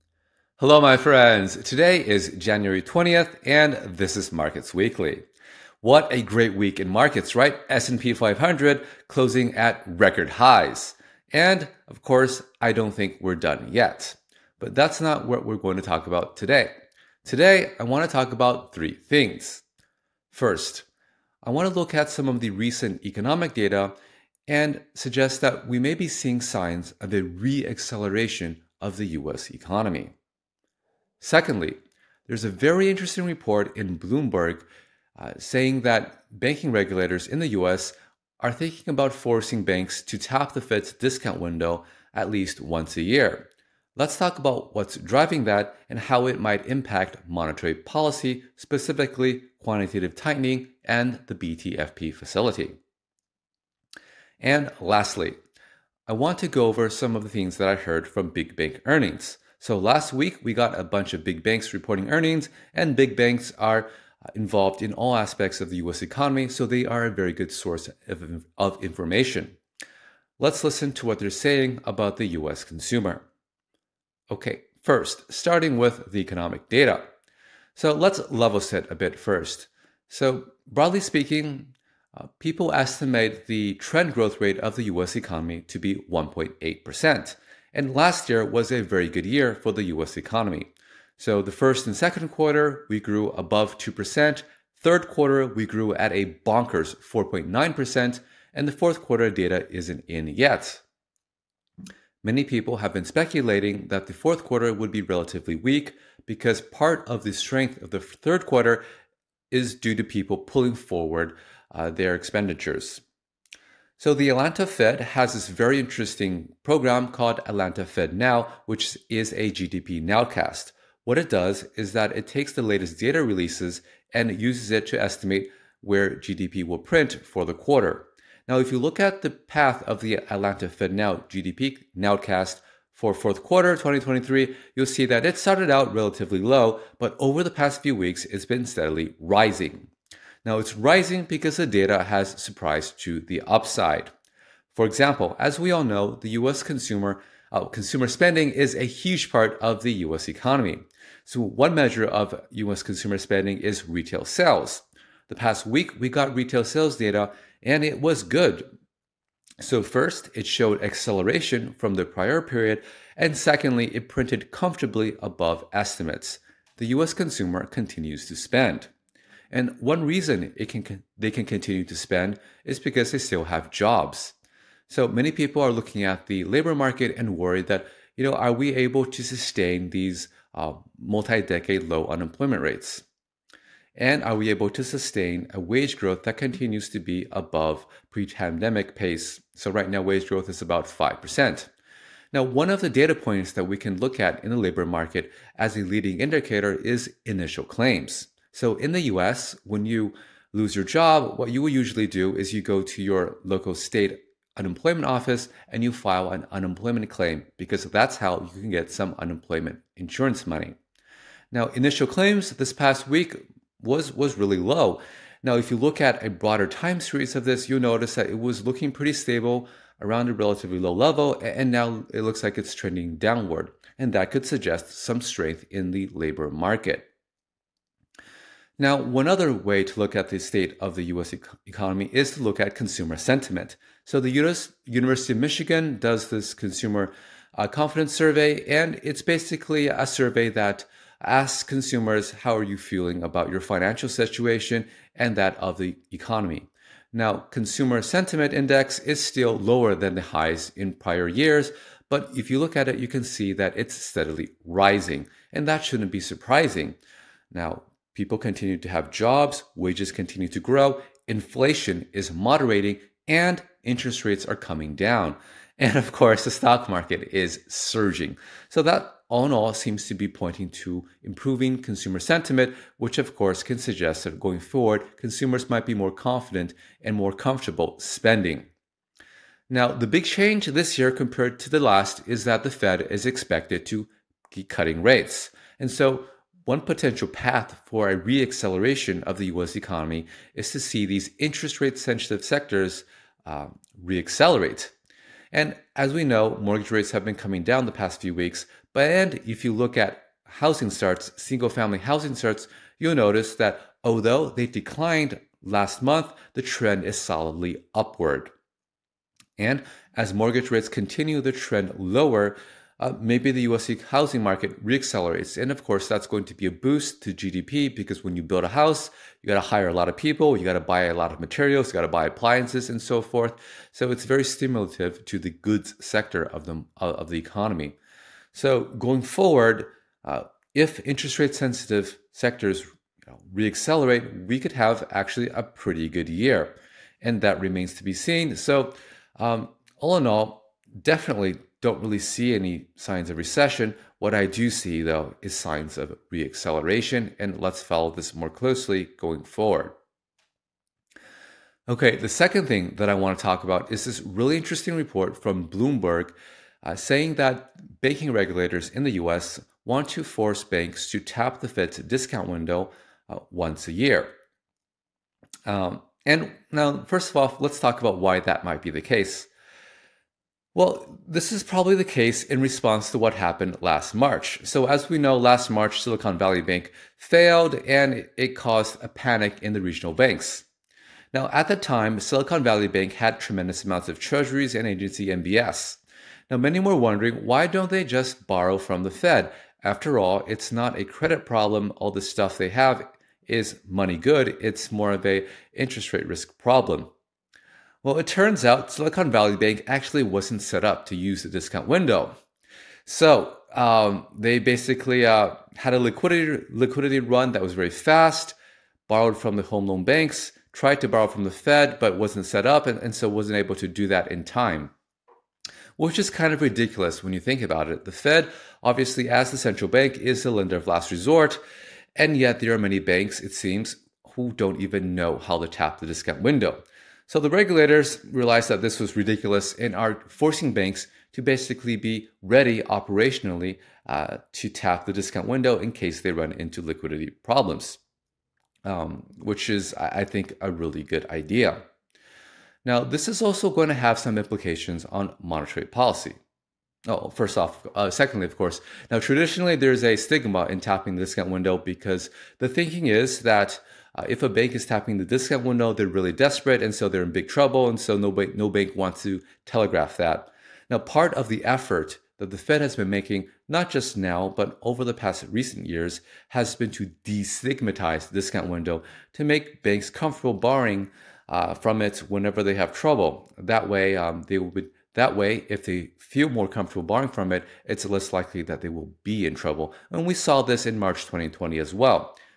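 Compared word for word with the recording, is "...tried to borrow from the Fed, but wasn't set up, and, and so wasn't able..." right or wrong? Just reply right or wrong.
right.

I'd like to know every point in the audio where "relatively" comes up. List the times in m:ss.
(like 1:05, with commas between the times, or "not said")
1:45, 2:15, 3:40.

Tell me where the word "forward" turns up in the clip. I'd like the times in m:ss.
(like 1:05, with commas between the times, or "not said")
1:50, 4:34, 5:29, 5:49.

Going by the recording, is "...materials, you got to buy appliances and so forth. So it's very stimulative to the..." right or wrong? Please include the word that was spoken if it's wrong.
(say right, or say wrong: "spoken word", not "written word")
right.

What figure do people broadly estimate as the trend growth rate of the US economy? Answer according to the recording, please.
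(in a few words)
1.8%.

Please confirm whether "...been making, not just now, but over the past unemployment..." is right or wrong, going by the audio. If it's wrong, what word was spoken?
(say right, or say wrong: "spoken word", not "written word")
wrong: "recent", not "unemployment".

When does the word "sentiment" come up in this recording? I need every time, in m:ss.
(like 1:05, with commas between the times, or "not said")
3:53, 4:08, 4:32.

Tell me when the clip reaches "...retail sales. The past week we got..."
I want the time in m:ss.
2:33.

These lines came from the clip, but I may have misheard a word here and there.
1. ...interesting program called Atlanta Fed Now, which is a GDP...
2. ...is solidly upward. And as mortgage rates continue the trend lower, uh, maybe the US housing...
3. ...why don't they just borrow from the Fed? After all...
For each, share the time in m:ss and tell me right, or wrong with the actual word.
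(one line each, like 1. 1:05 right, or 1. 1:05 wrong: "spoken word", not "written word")
1. 1:55 right
2. 5:07 right
3. 6:27 right.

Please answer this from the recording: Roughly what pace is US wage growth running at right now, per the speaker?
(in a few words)
About 5%.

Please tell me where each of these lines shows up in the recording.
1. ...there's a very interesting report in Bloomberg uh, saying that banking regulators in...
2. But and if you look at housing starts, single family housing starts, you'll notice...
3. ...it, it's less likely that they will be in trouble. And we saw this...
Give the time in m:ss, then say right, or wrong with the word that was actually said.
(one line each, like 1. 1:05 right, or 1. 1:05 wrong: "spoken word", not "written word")
1. 0:32 right
2. 4:58 right
3. 7:57 right.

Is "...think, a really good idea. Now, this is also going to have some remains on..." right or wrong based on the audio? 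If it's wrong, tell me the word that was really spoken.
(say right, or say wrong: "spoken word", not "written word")
wrong: "implications", not "remains".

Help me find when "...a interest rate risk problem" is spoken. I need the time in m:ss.
6:35.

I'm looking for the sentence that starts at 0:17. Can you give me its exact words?
Today, I want to talk about three things.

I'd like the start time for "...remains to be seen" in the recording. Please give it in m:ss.
5:37.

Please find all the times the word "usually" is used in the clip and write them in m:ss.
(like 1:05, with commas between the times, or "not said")
3:21.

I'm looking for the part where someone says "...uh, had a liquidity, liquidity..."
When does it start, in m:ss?
6:45.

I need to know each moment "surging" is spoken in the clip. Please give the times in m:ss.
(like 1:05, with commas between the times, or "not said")
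4:27.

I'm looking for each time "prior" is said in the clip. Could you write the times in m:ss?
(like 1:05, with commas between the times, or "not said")
2:42, 4:10.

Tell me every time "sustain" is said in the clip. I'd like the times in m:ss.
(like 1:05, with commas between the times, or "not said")
2:59, 3:04.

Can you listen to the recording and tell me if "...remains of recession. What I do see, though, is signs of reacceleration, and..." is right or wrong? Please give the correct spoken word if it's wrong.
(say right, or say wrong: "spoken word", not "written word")
wrong: "signs", not "remains".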